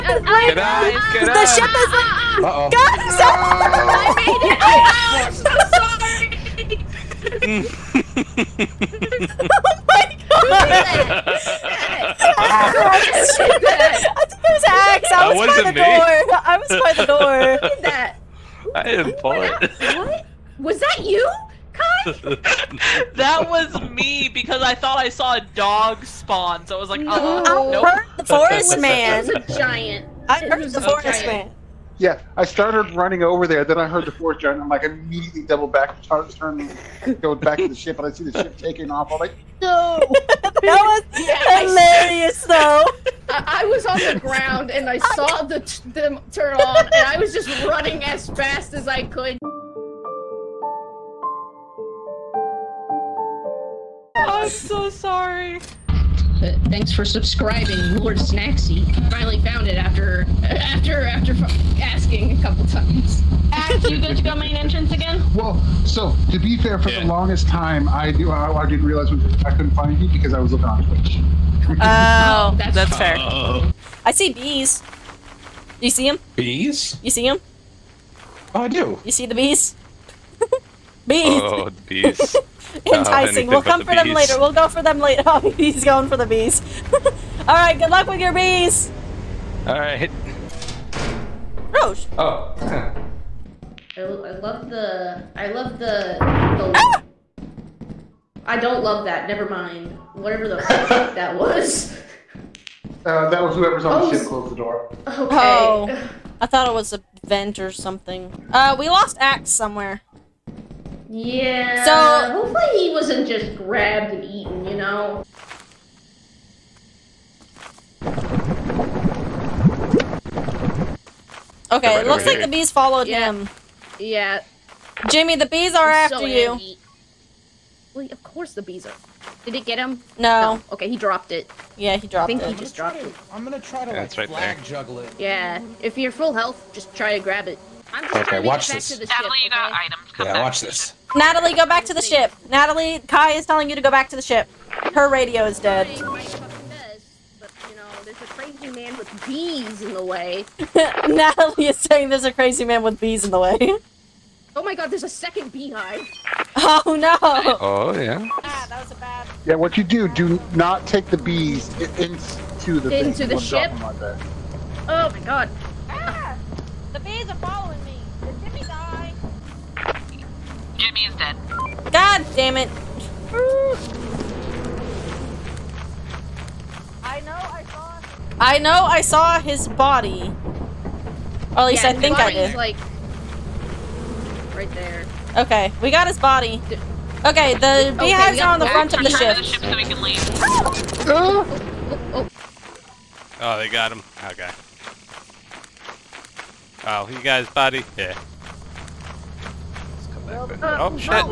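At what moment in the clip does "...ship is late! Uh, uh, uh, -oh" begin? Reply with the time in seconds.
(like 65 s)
5 s.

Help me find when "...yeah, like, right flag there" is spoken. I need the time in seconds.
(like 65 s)
133 s.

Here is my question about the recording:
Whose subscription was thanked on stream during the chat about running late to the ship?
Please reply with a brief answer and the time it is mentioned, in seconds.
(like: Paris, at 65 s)
Lord Snaxy, at 57 s.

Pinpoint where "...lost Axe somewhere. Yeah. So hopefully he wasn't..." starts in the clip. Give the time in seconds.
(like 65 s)
108 s.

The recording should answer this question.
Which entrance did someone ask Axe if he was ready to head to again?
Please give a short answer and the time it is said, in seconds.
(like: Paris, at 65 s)
main entrance, at 64 s.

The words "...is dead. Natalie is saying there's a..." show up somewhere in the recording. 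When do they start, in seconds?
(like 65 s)
145 s.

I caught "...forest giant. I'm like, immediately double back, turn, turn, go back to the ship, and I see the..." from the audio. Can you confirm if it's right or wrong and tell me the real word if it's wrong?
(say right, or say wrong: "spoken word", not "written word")
right.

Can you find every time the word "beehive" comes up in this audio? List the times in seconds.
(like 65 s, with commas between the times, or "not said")
155 s, 188 s.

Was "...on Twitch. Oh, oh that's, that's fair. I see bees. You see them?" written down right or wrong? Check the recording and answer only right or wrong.
right.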